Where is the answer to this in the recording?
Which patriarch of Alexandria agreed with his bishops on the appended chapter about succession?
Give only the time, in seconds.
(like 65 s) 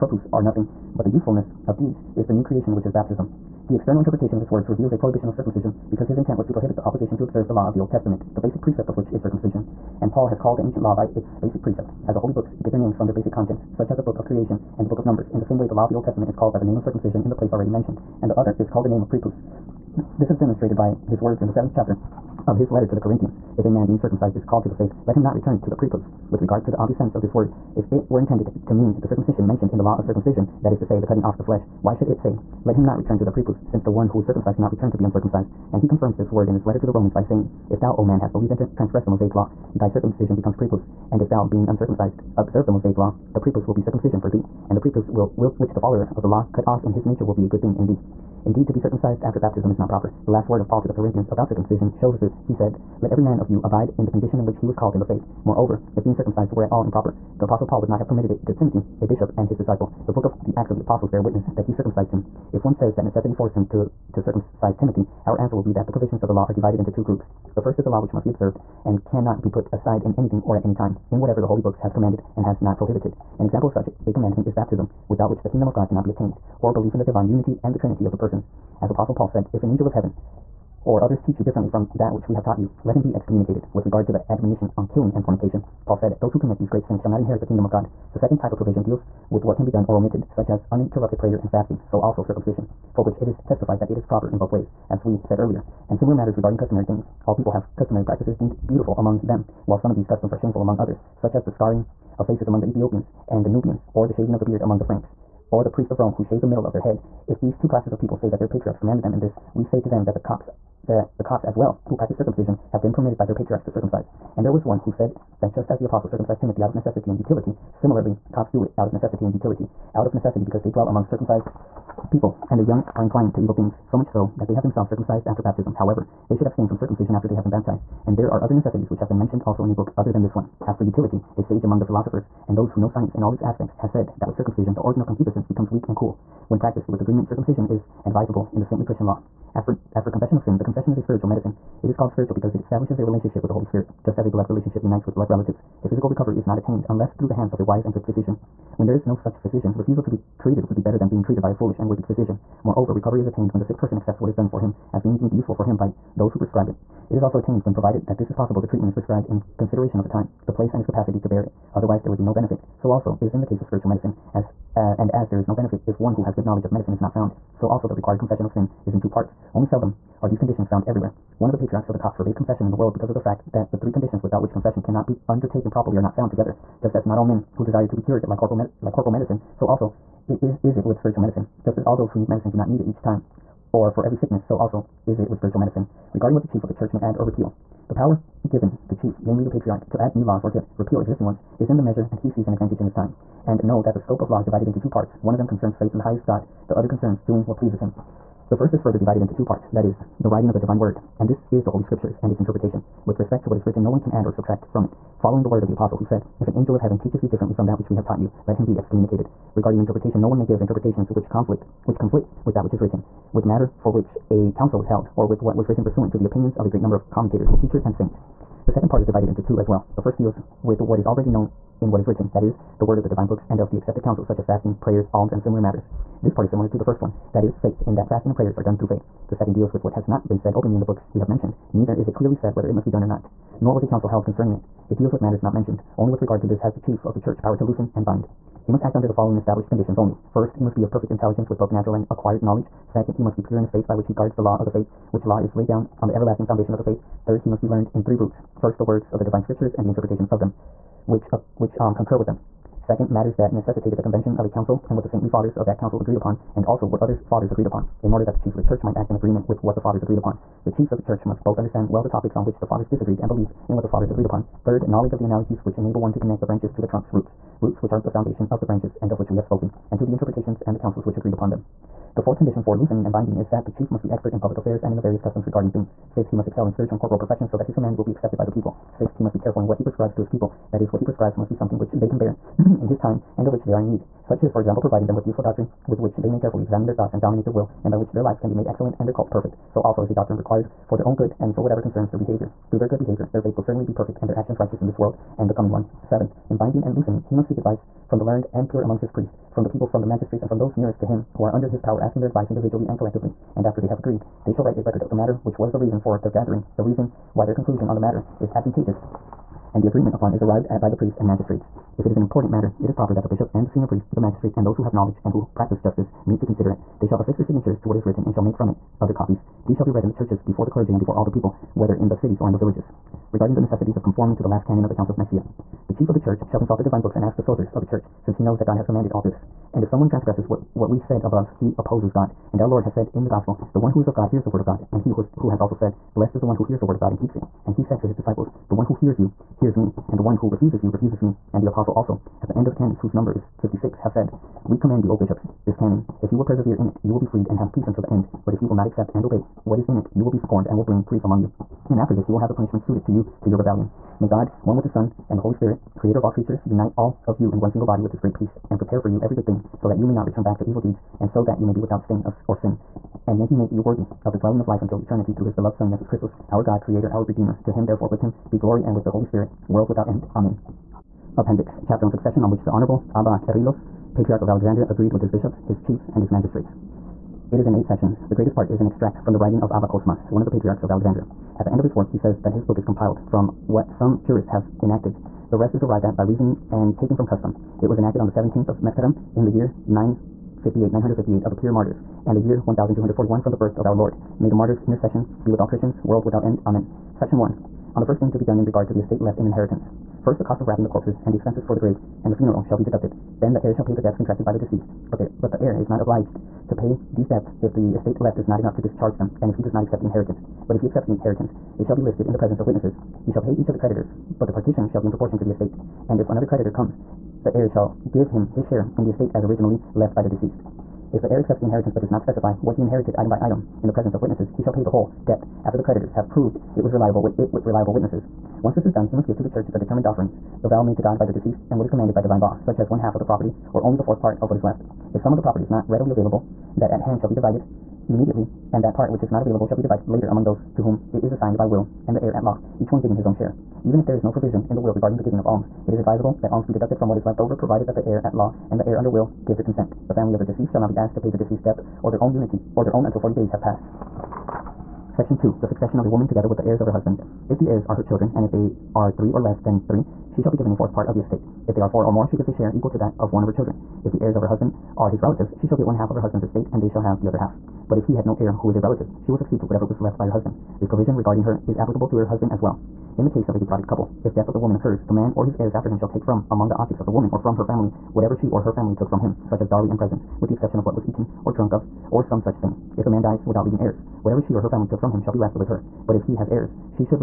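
373 s.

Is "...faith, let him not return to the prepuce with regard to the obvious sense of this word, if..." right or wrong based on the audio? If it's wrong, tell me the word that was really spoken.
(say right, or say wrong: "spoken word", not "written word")
right.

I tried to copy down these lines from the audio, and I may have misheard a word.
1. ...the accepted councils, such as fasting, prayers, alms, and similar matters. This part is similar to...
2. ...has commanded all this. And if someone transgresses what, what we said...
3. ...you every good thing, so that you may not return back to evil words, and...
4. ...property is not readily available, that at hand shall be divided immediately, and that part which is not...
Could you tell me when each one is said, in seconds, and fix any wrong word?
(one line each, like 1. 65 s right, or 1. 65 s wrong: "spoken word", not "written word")
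1. 223 s right
2. 328 s right
3. 359 s wrong: "deeds", not "words"
4. 435 s right.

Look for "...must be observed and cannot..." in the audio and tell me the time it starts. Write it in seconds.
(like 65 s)
68 s.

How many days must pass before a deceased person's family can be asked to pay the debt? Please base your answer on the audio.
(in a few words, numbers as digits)
40 days.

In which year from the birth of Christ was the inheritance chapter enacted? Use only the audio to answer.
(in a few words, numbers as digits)
1241.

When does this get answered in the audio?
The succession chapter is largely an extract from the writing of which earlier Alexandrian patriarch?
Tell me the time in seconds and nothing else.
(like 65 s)
379 s.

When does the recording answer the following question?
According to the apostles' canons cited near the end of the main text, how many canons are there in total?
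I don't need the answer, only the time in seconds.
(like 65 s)
343 s.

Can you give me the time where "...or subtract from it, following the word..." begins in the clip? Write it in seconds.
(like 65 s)
204 s.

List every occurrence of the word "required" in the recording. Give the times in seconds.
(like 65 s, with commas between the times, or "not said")
167 s, 290 s.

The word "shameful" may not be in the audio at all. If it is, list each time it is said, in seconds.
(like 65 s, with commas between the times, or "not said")
100 s.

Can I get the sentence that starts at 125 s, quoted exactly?
However, they should abstain from circumcision after they have been baptized.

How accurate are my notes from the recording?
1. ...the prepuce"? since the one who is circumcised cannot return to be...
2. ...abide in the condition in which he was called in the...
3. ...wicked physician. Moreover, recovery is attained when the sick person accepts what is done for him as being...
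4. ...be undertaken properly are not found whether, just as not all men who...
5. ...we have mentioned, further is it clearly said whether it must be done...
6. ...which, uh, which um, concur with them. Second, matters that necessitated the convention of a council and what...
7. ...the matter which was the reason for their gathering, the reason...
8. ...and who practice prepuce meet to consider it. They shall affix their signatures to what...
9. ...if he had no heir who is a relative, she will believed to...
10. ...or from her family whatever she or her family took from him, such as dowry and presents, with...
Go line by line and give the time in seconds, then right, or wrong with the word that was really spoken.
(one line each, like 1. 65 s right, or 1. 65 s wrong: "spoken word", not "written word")
1. 33 s right
2. 53 s right
3. 151 s right
4. 175 s wrong: "together", not "whether"
5. 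231 s wrong: "neither", not "further"
6. 251 s right
7. 305 s right
8. 315 s wrong: "justice", not "prepuce"
9. 467 s wrong: "succeed", not "believed"
10. 477 s right.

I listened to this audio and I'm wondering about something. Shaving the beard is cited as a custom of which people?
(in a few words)
The Franks.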